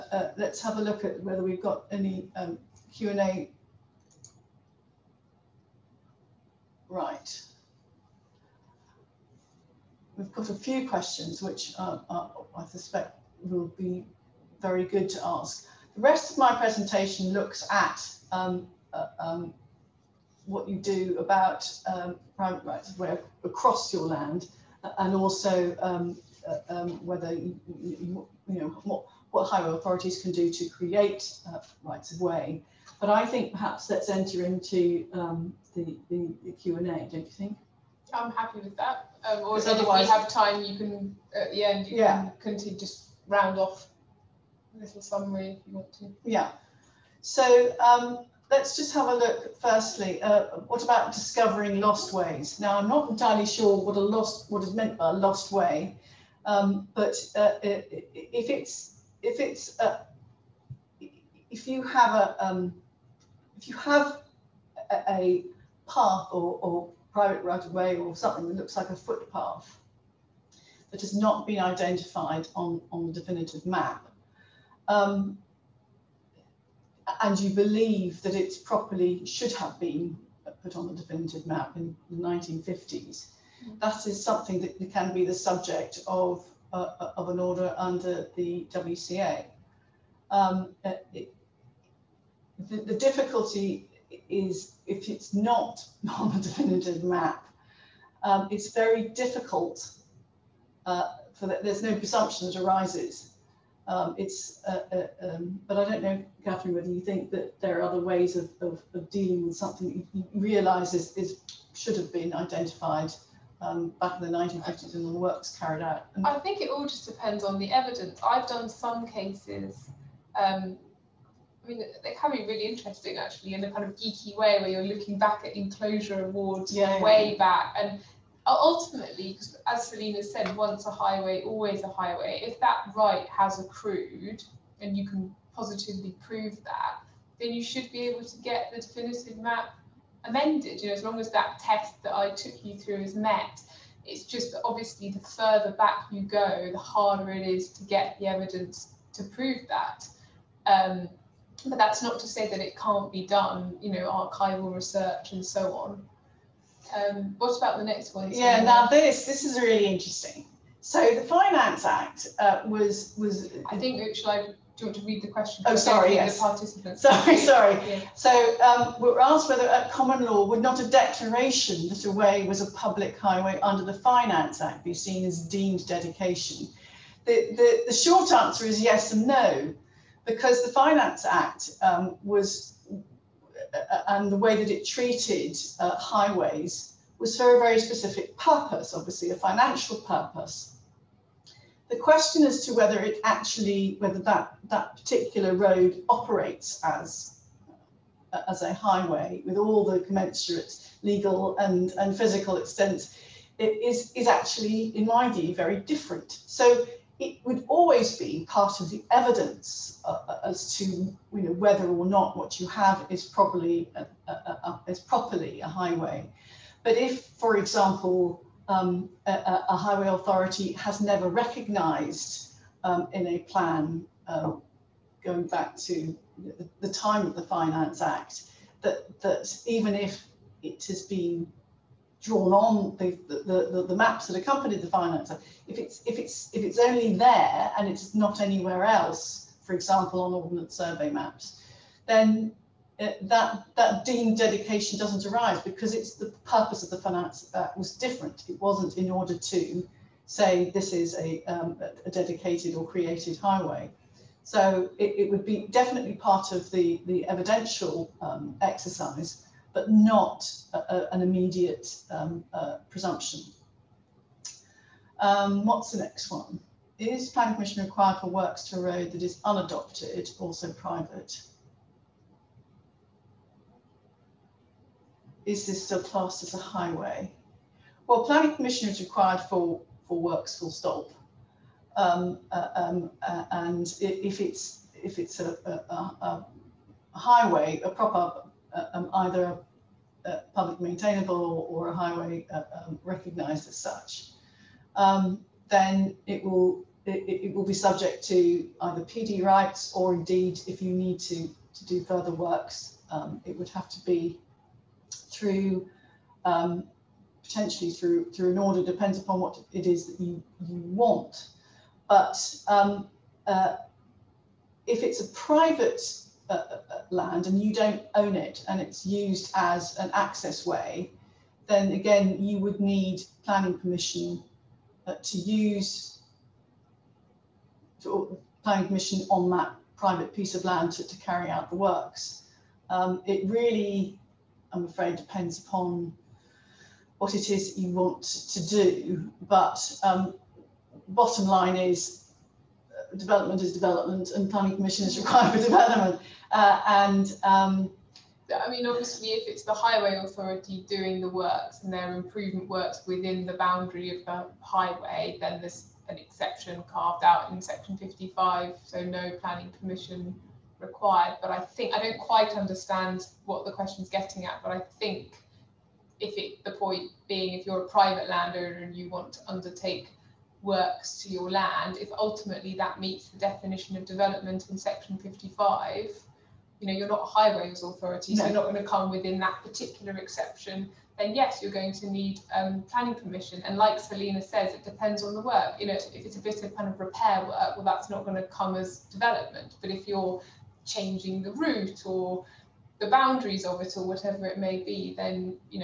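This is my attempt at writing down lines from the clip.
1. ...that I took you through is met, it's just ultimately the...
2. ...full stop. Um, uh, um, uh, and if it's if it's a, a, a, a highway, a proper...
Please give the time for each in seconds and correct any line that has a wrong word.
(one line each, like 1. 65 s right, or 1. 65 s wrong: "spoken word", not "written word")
1. 142 s wrong: "obviously", not "ultimately"
2. 280 s right.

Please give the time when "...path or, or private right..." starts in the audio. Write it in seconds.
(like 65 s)
65 s.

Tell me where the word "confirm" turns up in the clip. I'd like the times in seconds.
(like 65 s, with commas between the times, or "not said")
not said.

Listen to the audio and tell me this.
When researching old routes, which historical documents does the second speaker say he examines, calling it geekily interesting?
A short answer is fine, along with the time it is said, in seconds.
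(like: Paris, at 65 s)
Enclosure awards, at 125 s.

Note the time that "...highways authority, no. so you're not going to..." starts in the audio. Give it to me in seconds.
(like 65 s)
377 s.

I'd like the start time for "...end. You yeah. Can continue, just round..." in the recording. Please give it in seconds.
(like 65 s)
41 s.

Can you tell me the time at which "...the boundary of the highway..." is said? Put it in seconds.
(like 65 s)
353 s.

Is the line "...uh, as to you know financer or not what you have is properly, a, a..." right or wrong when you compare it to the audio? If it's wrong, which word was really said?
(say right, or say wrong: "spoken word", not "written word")
wrong: "whether", not "financer".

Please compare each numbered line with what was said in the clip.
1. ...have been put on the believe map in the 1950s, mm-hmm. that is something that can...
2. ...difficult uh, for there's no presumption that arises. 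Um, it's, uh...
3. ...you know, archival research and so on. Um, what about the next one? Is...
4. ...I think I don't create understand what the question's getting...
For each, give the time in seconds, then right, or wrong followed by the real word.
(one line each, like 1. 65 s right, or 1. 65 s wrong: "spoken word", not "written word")
1. 79 s wrong: "definitive", not "believe"
2. 99 s right
3. 153 s right
4. 361 s wrong: "quite", not "create".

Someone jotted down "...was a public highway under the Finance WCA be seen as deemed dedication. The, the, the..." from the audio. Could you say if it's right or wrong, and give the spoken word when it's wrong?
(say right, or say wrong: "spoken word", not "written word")
wrong: "Act", not "WCA".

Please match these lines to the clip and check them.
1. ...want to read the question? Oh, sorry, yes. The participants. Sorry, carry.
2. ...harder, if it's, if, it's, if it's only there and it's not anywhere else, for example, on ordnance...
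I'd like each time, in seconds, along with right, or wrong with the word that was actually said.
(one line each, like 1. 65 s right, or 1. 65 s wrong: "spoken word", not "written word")
1. 164 s wrong: "sorry", not "carry"
2. 234 s wrong: "financer", not "harder".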